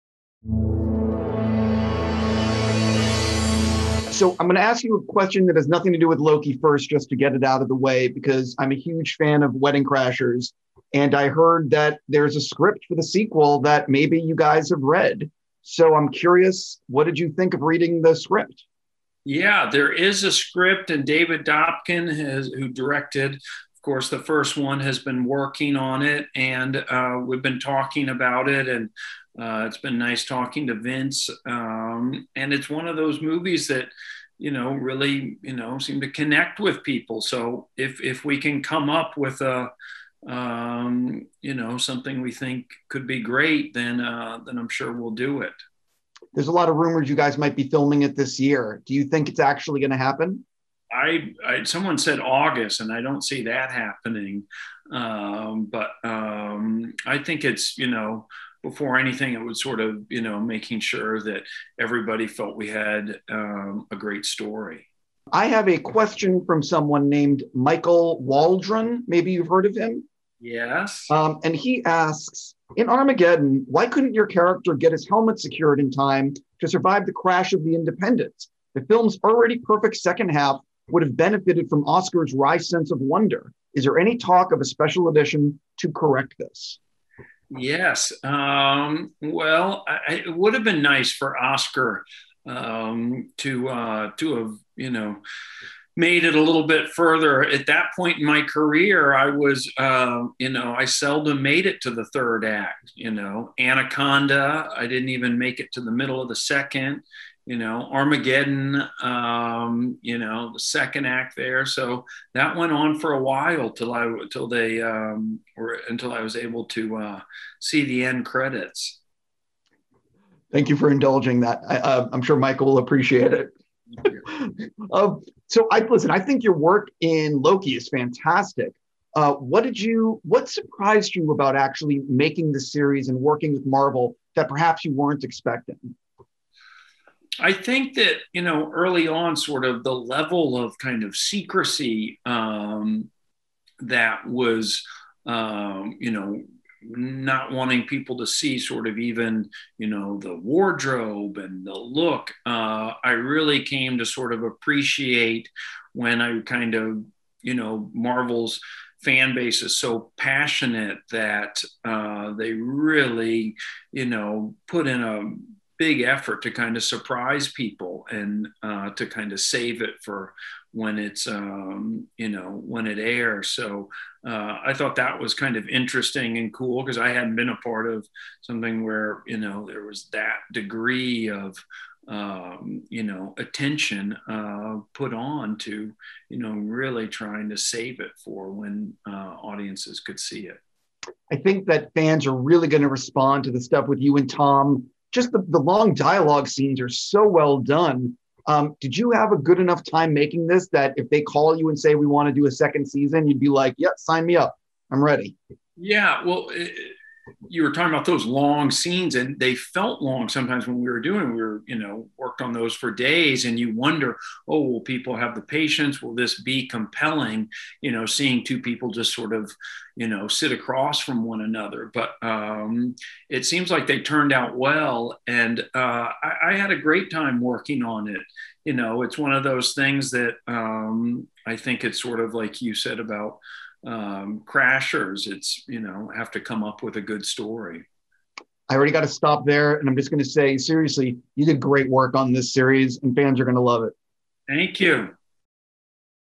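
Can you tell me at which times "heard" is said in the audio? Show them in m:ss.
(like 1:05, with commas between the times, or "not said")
0:11, 1:09.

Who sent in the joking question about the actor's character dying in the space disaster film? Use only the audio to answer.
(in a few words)
Michael Waldron.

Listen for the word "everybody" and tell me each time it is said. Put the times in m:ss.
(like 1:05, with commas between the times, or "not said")
1:01.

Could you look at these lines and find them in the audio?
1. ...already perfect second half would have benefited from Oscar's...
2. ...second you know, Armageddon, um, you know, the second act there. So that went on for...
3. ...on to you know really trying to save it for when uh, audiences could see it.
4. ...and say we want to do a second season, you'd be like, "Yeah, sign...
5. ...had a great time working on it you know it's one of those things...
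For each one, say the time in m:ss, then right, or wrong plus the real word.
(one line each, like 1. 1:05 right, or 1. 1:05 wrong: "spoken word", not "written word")
1. 1:19 right
2. 1:46 right
3. 3:05 right
4. 3:21 right
5. 3:46 right.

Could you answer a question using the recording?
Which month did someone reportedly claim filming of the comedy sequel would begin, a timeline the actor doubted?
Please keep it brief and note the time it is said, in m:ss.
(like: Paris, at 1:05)
August, at 0:52.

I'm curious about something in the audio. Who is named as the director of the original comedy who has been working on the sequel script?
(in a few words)
David Dobkin.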